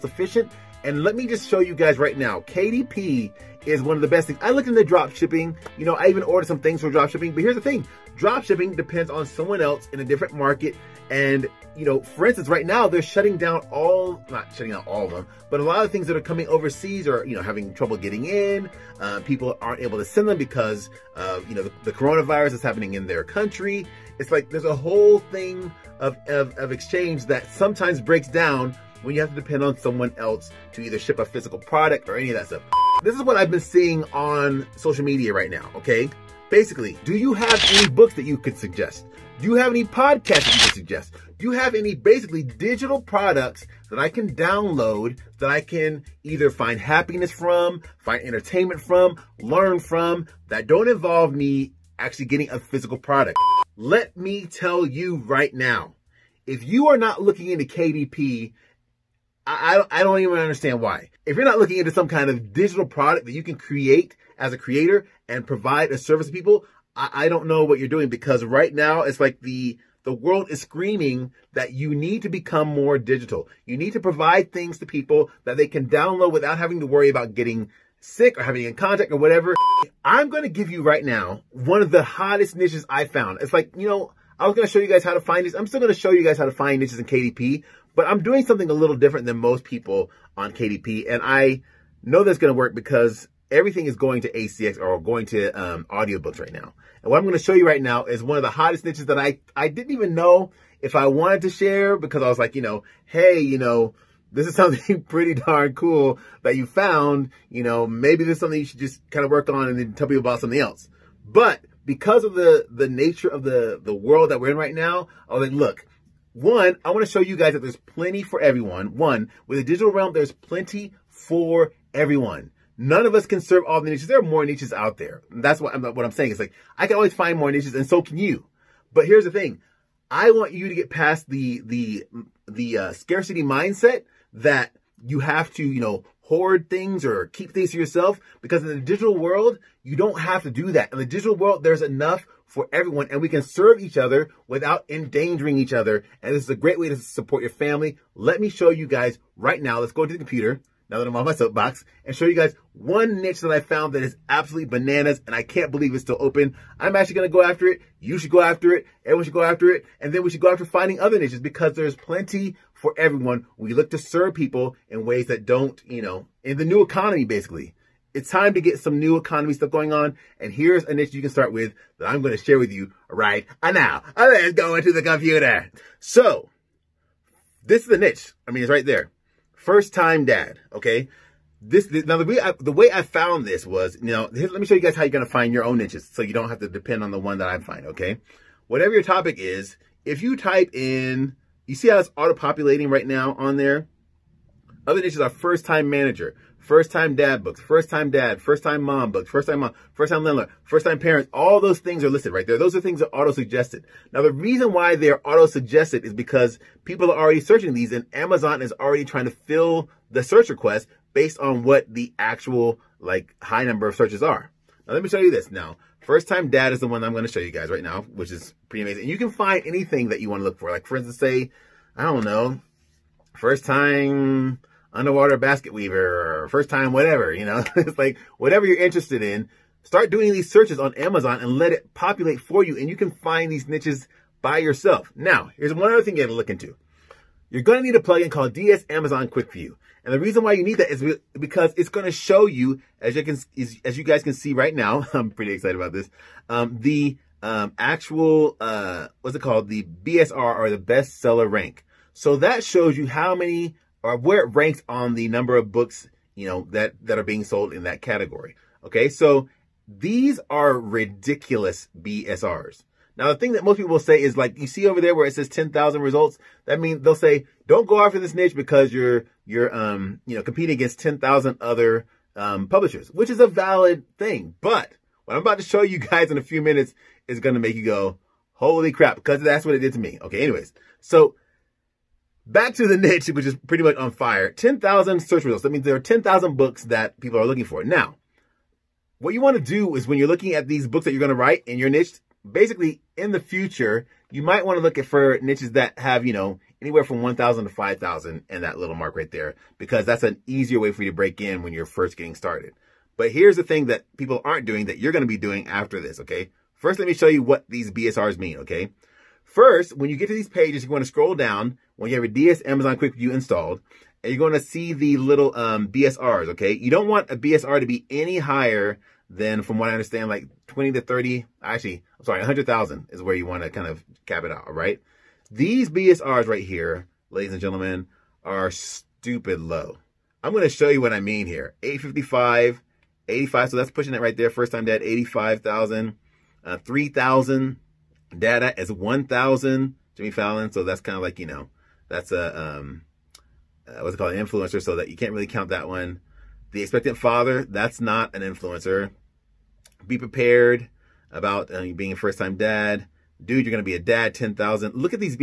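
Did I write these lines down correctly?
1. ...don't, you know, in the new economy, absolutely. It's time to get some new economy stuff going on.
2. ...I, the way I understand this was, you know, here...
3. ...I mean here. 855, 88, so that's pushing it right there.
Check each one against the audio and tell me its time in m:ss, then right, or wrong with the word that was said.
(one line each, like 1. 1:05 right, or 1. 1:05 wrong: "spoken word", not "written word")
1. 2:45 wrong: "basically", not "absolutely"
2. 3:02 wrong: "found", not "understand"
3. 5:31 wrong: "85", not "88".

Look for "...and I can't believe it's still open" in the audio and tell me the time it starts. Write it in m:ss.
2:35.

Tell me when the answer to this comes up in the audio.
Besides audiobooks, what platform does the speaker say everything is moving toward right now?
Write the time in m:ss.
1:34.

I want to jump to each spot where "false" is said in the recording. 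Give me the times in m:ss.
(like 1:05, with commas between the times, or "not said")
not said.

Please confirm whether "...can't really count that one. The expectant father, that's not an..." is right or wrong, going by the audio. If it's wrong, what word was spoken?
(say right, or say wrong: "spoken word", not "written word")
right.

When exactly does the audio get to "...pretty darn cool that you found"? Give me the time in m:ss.
1:45.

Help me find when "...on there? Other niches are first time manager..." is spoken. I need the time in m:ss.
3:13.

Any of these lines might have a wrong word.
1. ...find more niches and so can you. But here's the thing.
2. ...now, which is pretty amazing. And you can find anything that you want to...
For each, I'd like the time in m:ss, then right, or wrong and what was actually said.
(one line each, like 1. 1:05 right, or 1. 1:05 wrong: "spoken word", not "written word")
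1. 2:07 right
2. 3:37 right.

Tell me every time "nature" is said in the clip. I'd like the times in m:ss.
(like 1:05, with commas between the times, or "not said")
1:52.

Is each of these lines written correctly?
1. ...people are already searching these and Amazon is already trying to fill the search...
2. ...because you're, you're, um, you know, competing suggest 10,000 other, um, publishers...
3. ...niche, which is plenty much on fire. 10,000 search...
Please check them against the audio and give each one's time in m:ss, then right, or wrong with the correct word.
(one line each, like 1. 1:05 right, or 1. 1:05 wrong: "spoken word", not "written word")
1. 3:26 right
2. 4:28 wrong: "against", not "suggest"
3. 4:42 wrong: "pretty", not "plenty".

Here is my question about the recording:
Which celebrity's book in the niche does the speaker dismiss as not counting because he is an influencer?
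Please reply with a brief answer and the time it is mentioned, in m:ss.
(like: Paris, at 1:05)
Jimmy Fallon, at 5:40.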